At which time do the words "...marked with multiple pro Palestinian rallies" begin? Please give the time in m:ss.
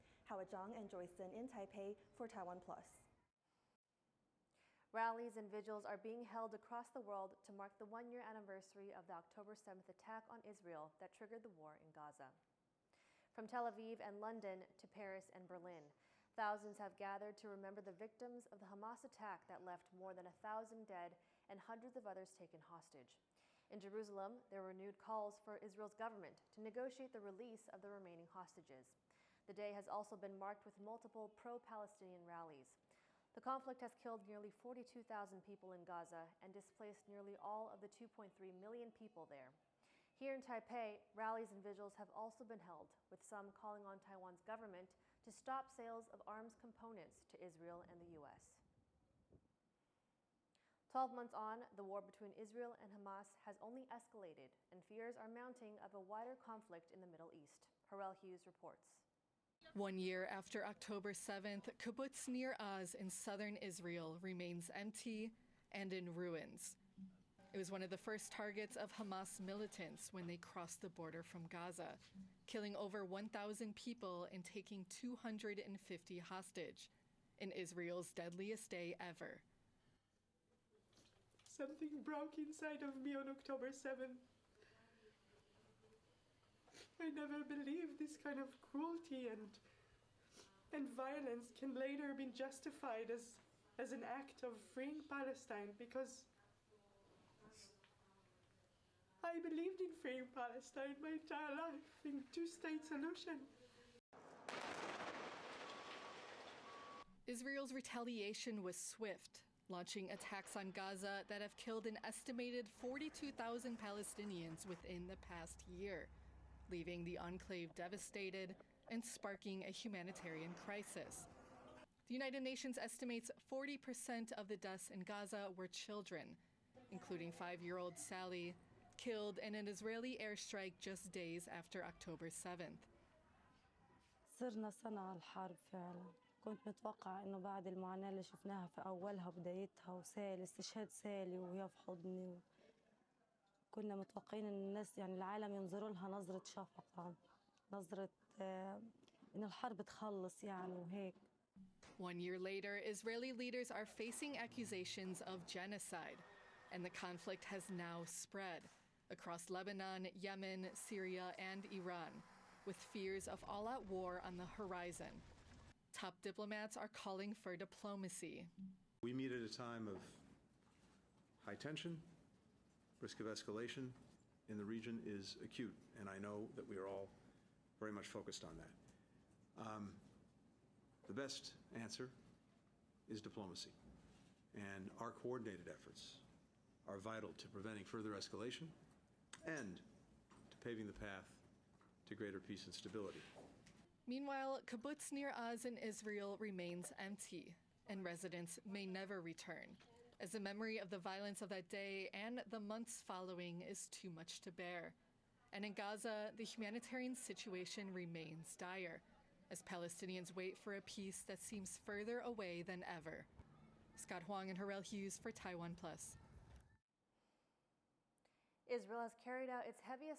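0:30.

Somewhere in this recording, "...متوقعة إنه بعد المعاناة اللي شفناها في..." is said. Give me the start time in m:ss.
2:16.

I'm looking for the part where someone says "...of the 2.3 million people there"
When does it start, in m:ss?
0:37.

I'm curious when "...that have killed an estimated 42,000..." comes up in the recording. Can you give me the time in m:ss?
1:51.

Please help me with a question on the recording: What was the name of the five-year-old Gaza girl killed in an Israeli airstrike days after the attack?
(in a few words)
Sally.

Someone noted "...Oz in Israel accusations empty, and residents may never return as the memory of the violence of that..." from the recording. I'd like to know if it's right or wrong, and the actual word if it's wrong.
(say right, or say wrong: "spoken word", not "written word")
wrong: "remains", not "accusations".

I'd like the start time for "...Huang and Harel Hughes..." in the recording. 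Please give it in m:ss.
3:34.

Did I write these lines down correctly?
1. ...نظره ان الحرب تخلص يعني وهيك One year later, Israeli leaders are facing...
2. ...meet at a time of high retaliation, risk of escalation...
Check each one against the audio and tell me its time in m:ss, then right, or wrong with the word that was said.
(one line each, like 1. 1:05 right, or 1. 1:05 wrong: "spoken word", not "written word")
1. 2:27 right
2. 2:49 wrong: "tension", not "retaliation".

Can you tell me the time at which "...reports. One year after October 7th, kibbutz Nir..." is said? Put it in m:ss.
0:58.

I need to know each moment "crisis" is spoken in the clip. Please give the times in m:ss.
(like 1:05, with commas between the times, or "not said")
2:00.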